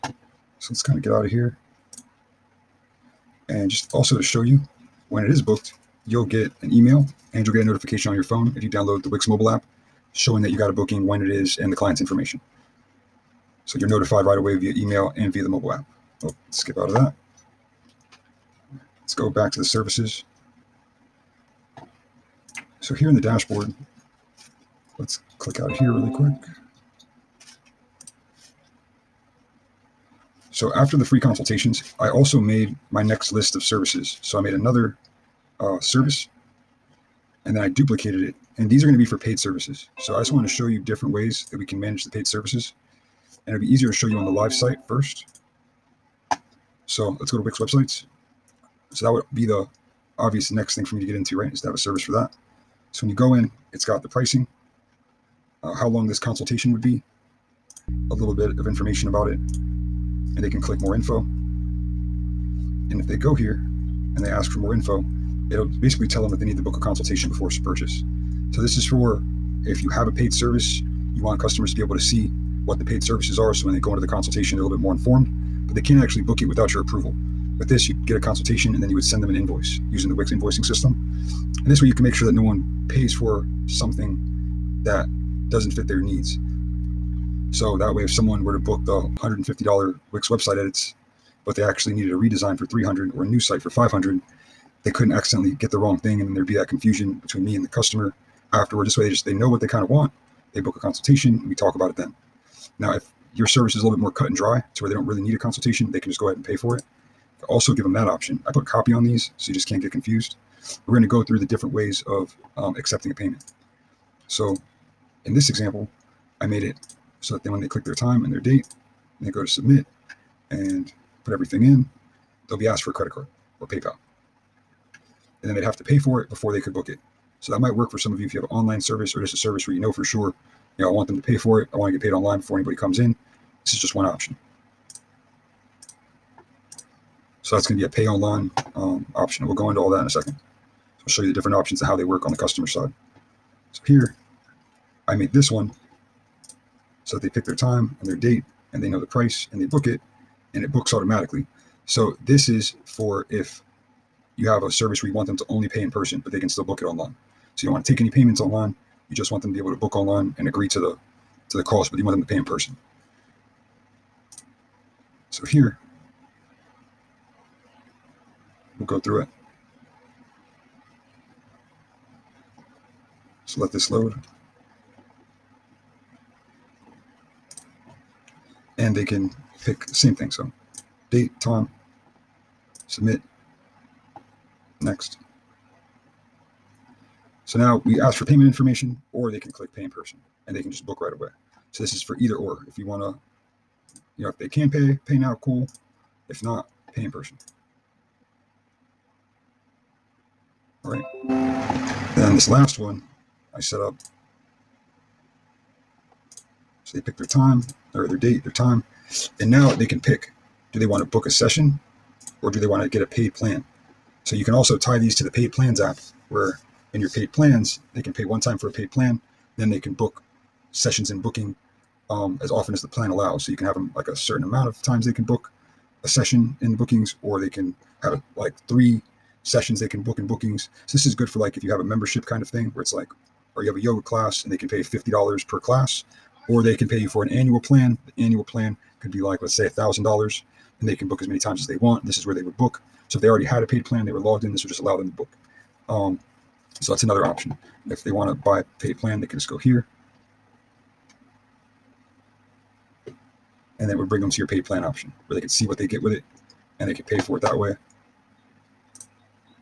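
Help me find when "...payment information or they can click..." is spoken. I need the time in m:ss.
3:08.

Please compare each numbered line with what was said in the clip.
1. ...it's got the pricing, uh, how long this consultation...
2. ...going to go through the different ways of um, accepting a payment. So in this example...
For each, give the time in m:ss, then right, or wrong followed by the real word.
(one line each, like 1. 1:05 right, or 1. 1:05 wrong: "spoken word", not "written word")
1. 0:53 right
2. 1:50 right.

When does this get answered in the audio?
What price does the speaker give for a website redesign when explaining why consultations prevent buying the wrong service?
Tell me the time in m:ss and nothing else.
1:32.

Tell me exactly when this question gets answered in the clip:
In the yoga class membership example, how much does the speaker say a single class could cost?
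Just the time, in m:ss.
3:54.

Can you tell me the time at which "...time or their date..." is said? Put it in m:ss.
3:27.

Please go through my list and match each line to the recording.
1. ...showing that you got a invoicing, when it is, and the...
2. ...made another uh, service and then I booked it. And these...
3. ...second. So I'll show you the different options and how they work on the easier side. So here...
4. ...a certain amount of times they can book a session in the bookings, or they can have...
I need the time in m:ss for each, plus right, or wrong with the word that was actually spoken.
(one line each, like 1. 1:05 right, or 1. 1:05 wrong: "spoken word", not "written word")
1. 0:10 wrong: "booking", not "invoicing"
2. 0:34 wrong: "duplicated", not "booked"
3. 2:20 wrong: "customer", not "easier"
4. 3:44 right.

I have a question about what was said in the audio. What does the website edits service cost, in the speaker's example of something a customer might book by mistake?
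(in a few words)
$150.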